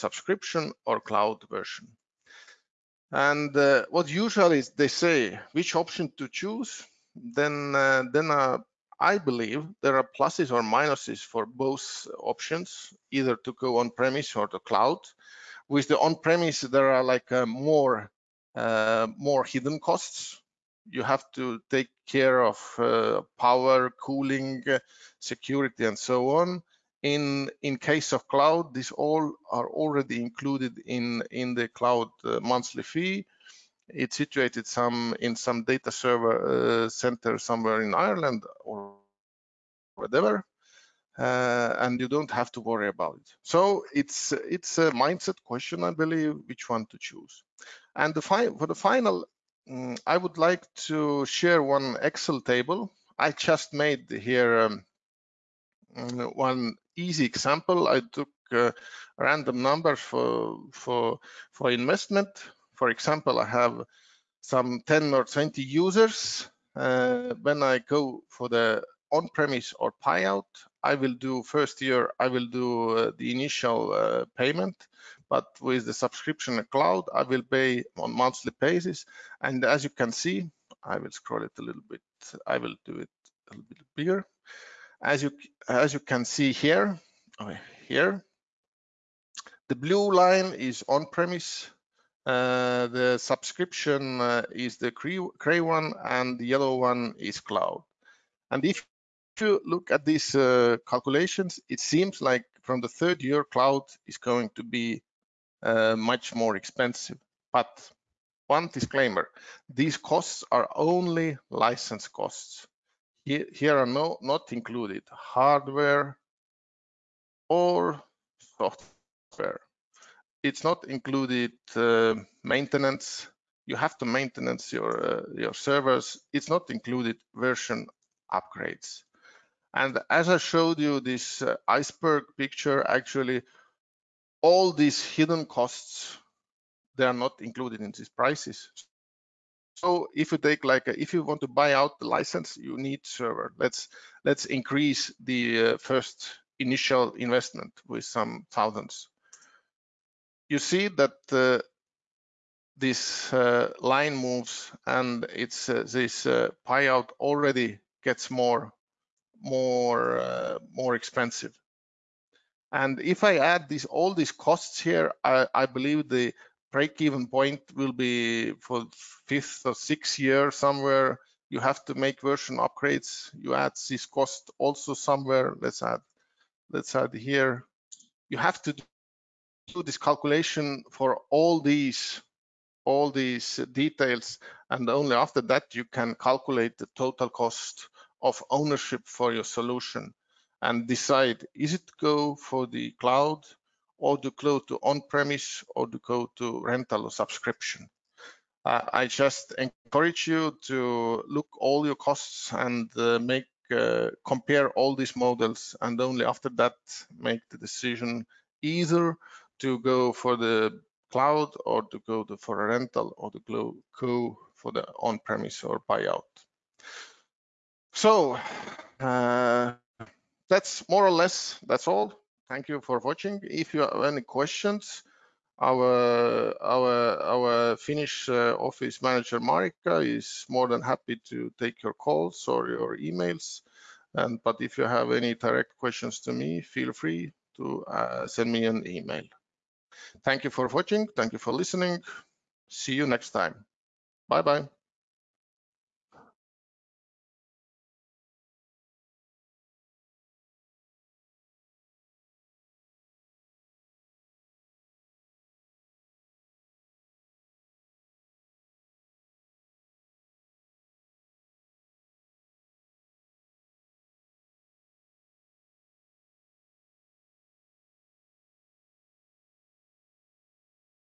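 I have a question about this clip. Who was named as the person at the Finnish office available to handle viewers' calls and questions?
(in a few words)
Marika.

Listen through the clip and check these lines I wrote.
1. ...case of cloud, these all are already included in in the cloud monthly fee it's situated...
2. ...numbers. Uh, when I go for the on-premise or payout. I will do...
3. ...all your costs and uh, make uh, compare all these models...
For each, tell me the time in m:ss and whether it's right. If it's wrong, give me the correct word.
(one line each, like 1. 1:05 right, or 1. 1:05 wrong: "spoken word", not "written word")
1. 0:27 right
2. 1:05 wrong: "users", not "numbers"
3. 3:21 right.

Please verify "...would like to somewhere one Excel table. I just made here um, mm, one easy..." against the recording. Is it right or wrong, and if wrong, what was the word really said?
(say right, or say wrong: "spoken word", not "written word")
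wrong: "share", not "somewhere".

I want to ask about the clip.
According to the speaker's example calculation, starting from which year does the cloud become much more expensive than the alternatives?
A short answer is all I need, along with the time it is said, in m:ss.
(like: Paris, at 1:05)
Third year, at 1:42.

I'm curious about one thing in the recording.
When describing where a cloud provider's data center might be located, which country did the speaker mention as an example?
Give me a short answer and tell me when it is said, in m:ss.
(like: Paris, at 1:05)
Ireland, at 0:37.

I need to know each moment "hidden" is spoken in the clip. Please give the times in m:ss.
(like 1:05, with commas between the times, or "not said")
0:19, 2:15.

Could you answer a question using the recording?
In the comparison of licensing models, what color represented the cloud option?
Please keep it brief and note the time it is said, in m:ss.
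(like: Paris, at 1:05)
Yellow, at 1:36.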